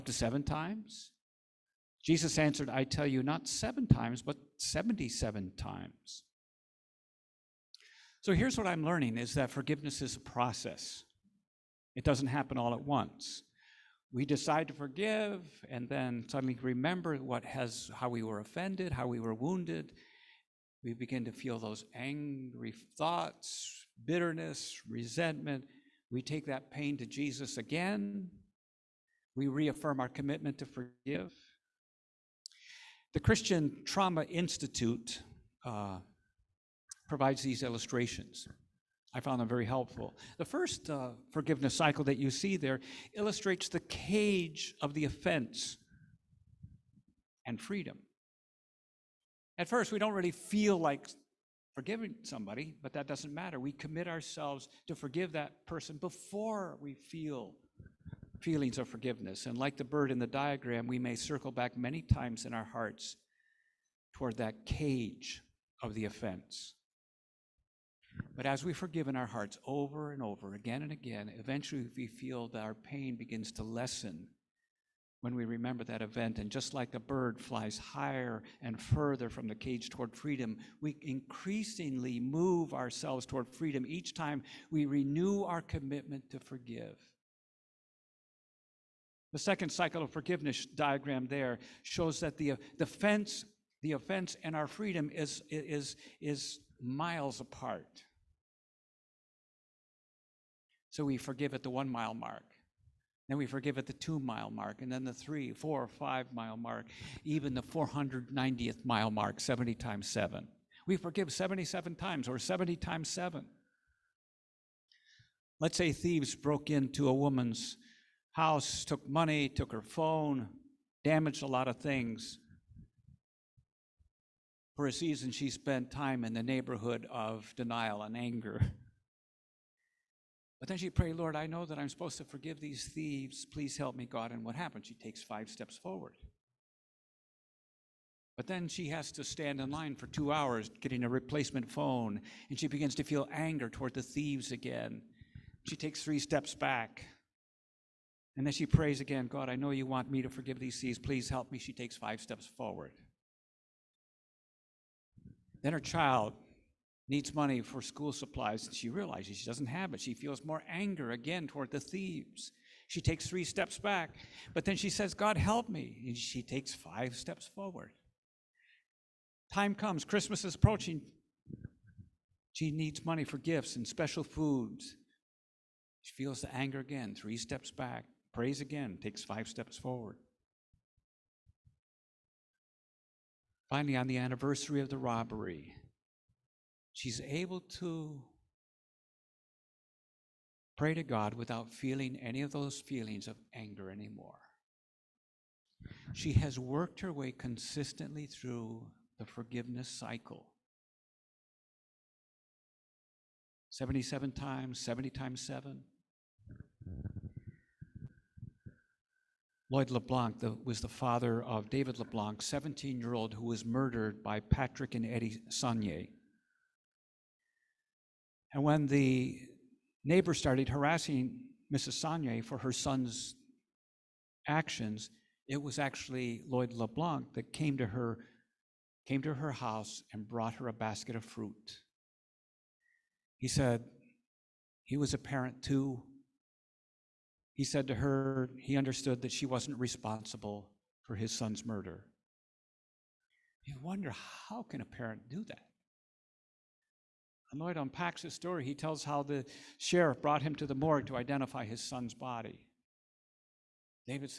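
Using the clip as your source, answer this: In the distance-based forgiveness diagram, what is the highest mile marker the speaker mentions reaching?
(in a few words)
490th.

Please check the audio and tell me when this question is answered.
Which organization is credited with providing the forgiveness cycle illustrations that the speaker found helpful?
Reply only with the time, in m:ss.
0:33.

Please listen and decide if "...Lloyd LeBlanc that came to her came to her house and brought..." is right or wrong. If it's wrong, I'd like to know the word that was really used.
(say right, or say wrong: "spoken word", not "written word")
right.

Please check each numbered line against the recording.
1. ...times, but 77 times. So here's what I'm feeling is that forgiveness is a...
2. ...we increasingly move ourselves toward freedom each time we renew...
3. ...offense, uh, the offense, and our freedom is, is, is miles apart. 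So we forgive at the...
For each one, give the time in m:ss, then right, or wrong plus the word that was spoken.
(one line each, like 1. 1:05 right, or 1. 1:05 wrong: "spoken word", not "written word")
1. 0:03 wrong: "learning", not "feeling"
2. 1:20 right
3. 1:32 right.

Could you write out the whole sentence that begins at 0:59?
And like the bird in the diagram, we may circle back many times in our hearts toward that cage of the offense.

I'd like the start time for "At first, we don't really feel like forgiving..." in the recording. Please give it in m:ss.
0:49.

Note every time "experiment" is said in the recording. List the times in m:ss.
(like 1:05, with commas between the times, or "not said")
not said.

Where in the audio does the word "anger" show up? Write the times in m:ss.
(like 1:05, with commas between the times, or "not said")
2:08, 2:23, 2:40, 2:56, 3:13.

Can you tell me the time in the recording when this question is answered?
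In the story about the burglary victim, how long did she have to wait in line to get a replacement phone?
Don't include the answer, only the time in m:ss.
2:20.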